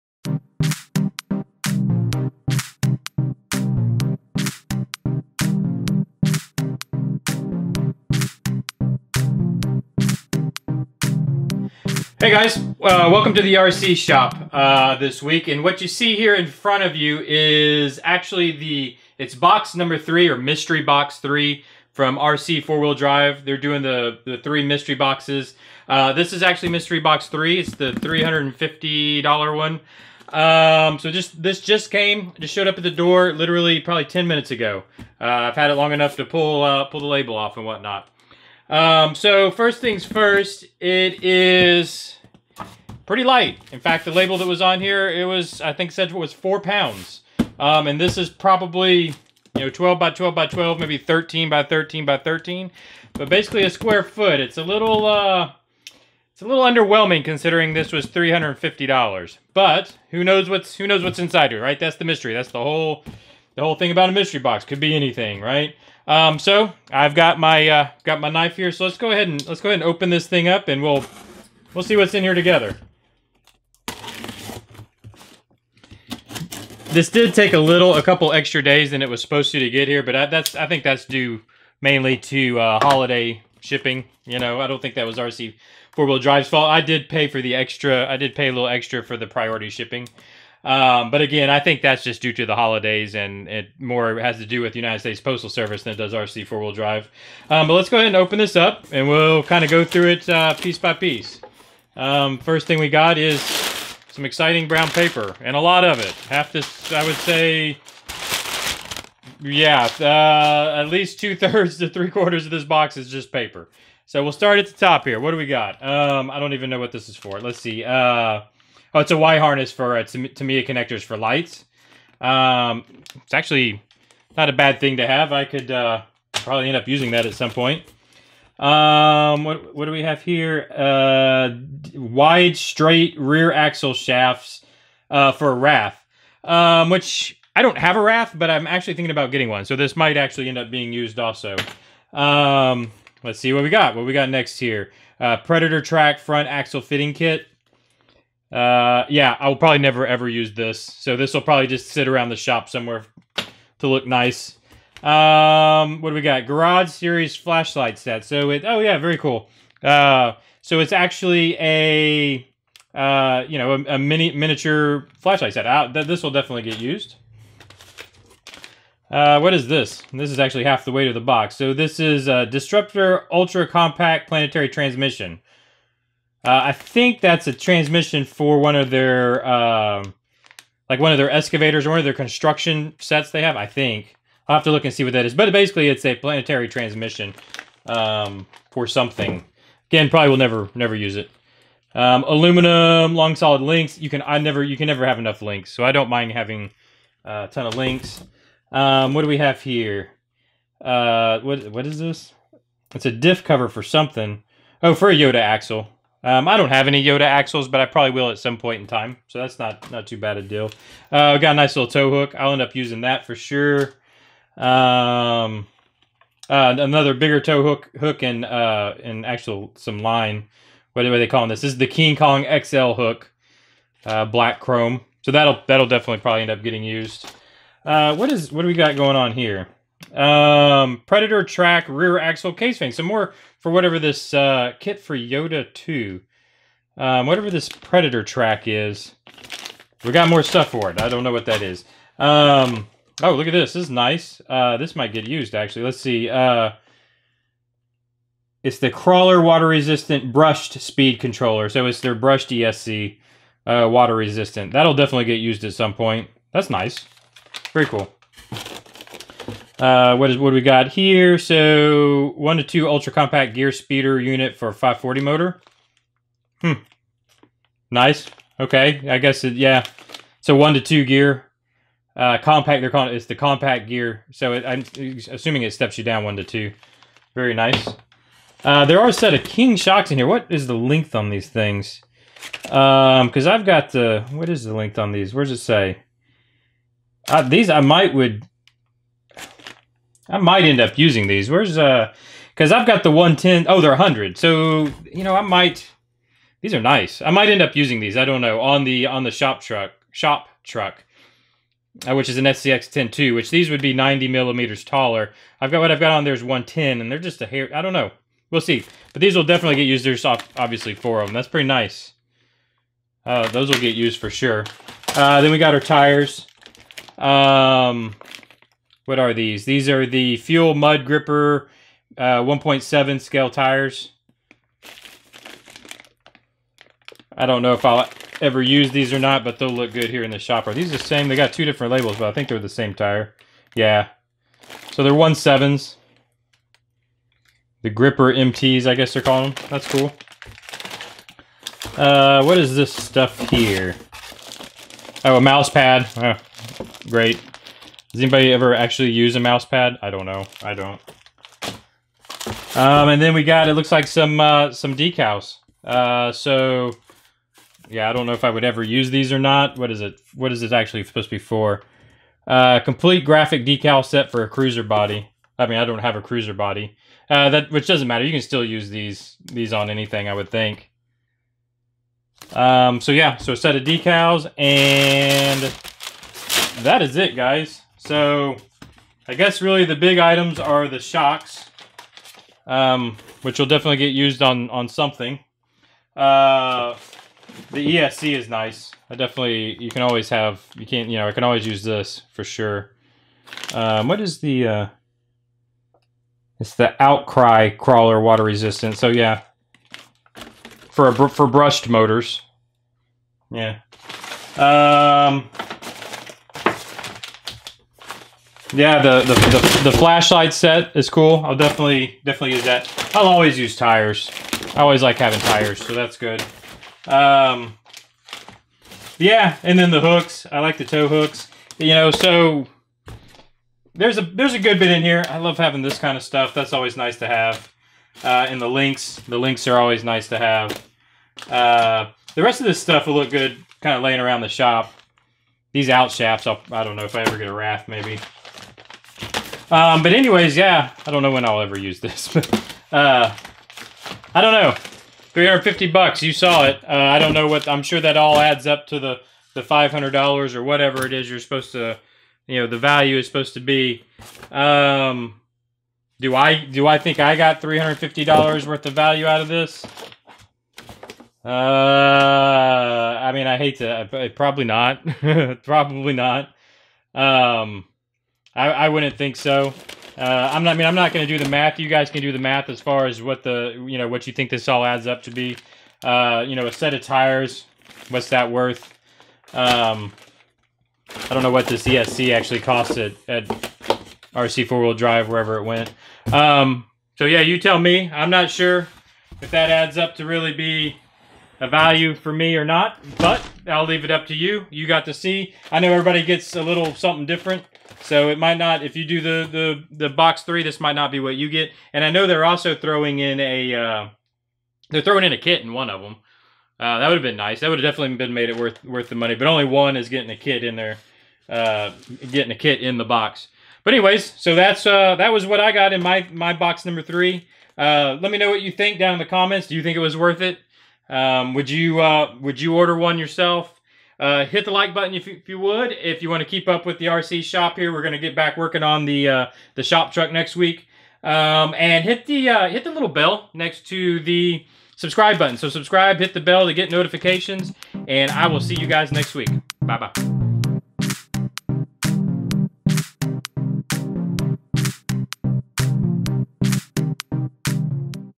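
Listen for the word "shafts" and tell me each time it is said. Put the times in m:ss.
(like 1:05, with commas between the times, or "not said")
2:13, 7:16.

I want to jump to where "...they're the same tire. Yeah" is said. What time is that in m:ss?
5:32.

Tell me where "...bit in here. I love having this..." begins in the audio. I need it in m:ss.
7:04.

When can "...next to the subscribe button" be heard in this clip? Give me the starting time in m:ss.
8:53.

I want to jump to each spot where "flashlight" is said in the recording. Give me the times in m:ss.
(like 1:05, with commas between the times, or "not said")
2:37, 2:45, 6:49.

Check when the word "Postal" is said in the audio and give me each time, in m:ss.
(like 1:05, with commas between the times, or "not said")
1:35.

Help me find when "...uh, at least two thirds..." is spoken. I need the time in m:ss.
1:49.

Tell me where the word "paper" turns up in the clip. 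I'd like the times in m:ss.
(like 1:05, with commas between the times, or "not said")
1:44, 1:53.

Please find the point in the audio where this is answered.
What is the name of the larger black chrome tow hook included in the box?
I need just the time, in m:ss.
3:41.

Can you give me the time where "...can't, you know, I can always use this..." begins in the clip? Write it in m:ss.
6:30.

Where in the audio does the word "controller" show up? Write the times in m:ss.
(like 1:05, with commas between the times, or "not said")
4:11.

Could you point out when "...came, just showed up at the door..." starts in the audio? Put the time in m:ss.
0:31.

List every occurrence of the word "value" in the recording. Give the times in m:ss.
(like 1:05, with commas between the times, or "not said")
7:32, 7:38, 8:11.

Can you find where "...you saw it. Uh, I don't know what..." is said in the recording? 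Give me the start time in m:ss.
7:26.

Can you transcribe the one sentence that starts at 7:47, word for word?
Um, I, I wouldn't think so.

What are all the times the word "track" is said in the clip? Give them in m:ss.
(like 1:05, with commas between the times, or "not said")
2:25, 3:51, 3:58.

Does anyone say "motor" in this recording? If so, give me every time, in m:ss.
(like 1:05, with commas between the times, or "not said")
4:25, 6:41.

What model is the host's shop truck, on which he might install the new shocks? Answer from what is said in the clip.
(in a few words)
SCX 10.2.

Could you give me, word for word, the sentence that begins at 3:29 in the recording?
So that's not not too bad a deal.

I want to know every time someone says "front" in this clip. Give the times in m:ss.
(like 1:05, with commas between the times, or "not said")
0:16, 2:26.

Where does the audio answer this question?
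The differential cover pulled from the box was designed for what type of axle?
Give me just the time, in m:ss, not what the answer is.
3:25.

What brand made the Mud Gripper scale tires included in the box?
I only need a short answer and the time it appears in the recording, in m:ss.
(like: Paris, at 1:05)
Fuel, at 5:20.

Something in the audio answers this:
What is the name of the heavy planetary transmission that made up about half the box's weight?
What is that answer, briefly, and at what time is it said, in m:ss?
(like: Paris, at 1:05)
Disruptor Ultra Compact, at 2:52.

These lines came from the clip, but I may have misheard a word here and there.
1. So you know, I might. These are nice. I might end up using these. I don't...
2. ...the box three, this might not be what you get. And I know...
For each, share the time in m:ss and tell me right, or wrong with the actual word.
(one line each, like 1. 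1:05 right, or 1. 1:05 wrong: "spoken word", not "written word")
1. 4:54 right
2. 8:19 right.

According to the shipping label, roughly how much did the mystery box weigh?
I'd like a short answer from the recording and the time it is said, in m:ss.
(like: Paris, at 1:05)
4 pounds, at 0:46.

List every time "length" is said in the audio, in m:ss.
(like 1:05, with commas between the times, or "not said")
4:40, 4:44.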